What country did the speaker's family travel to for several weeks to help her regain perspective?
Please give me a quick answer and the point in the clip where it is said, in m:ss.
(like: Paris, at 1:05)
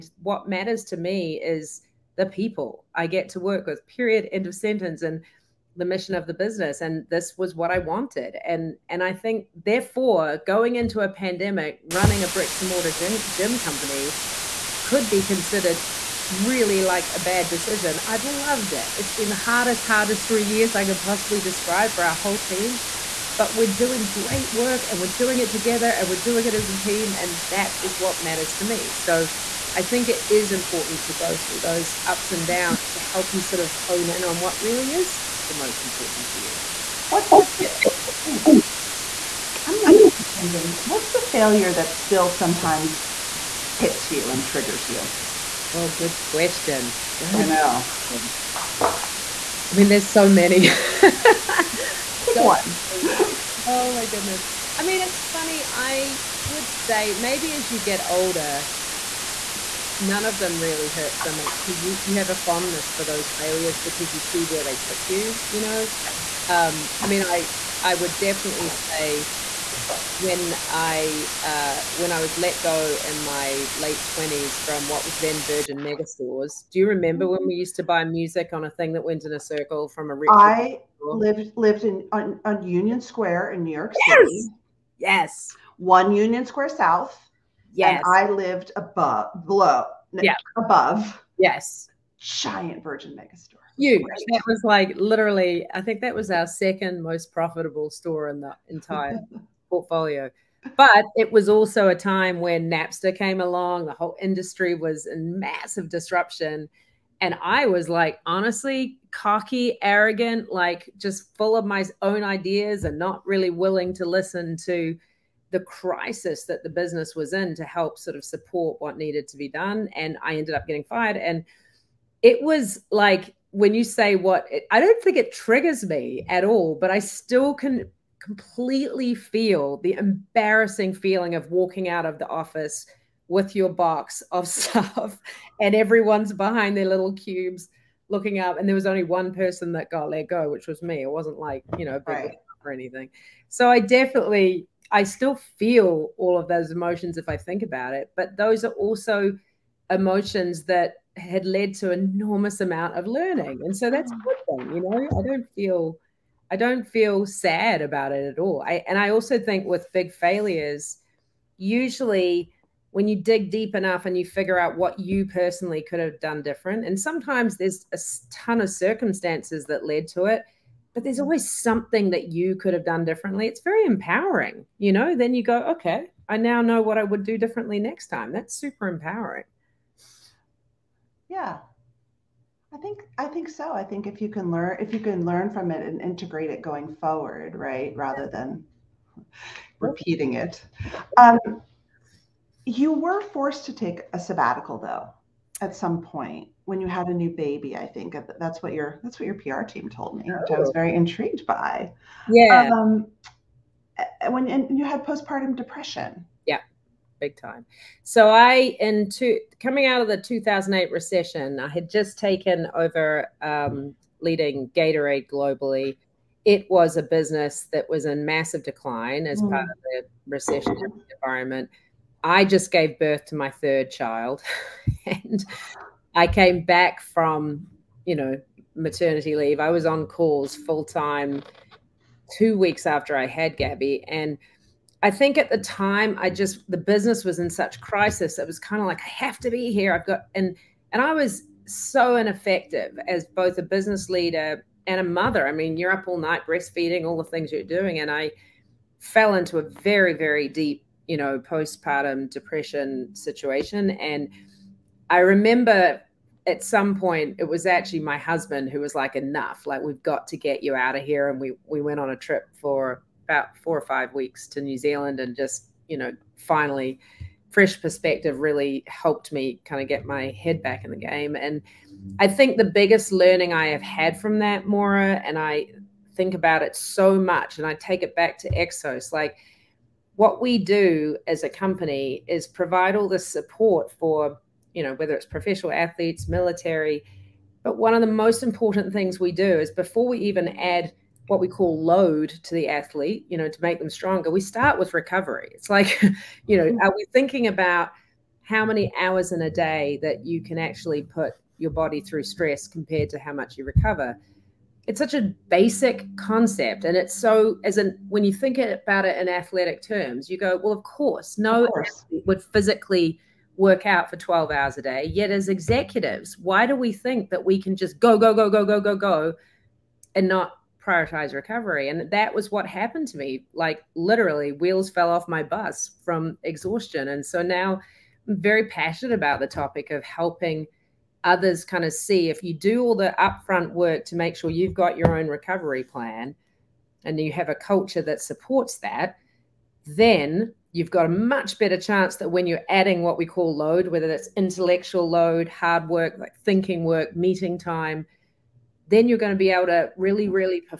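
New Zealand, at 4:24.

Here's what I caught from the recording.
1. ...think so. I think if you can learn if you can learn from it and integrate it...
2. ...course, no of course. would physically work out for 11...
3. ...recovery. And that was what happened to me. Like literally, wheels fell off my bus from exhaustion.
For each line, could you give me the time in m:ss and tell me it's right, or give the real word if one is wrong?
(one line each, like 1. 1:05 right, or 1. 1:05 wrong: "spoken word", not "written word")
1. 3:03 right
2. 5:10 wrong: "12", not "11"
3. 5:21 right.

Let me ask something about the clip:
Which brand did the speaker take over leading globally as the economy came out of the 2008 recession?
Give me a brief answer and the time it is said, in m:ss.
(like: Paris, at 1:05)
Gatorade, at 3:34.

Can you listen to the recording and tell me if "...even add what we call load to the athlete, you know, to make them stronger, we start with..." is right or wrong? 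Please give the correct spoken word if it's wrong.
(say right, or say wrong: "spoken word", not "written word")
right.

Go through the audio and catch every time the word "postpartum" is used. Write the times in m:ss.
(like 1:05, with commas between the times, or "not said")
3:25, 4:11.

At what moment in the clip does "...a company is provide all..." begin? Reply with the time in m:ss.
4:41.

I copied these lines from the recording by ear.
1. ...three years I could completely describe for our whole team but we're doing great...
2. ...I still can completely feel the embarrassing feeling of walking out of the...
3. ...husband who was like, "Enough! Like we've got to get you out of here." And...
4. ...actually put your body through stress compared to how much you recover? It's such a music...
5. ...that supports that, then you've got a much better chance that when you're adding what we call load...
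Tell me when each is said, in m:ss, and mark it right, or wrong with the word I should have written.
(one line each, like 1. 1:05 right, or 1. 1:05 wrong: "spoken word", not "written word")
1. 0:20 wrong: "possibly", not "completely"
2. 2:06 right
3. 4:18 right
4. 5:00 wrong: "basic", not "music"
5. 5:38 right.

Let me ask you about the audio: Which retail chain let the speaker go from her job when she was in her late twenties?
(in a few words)
Virgin Megastores.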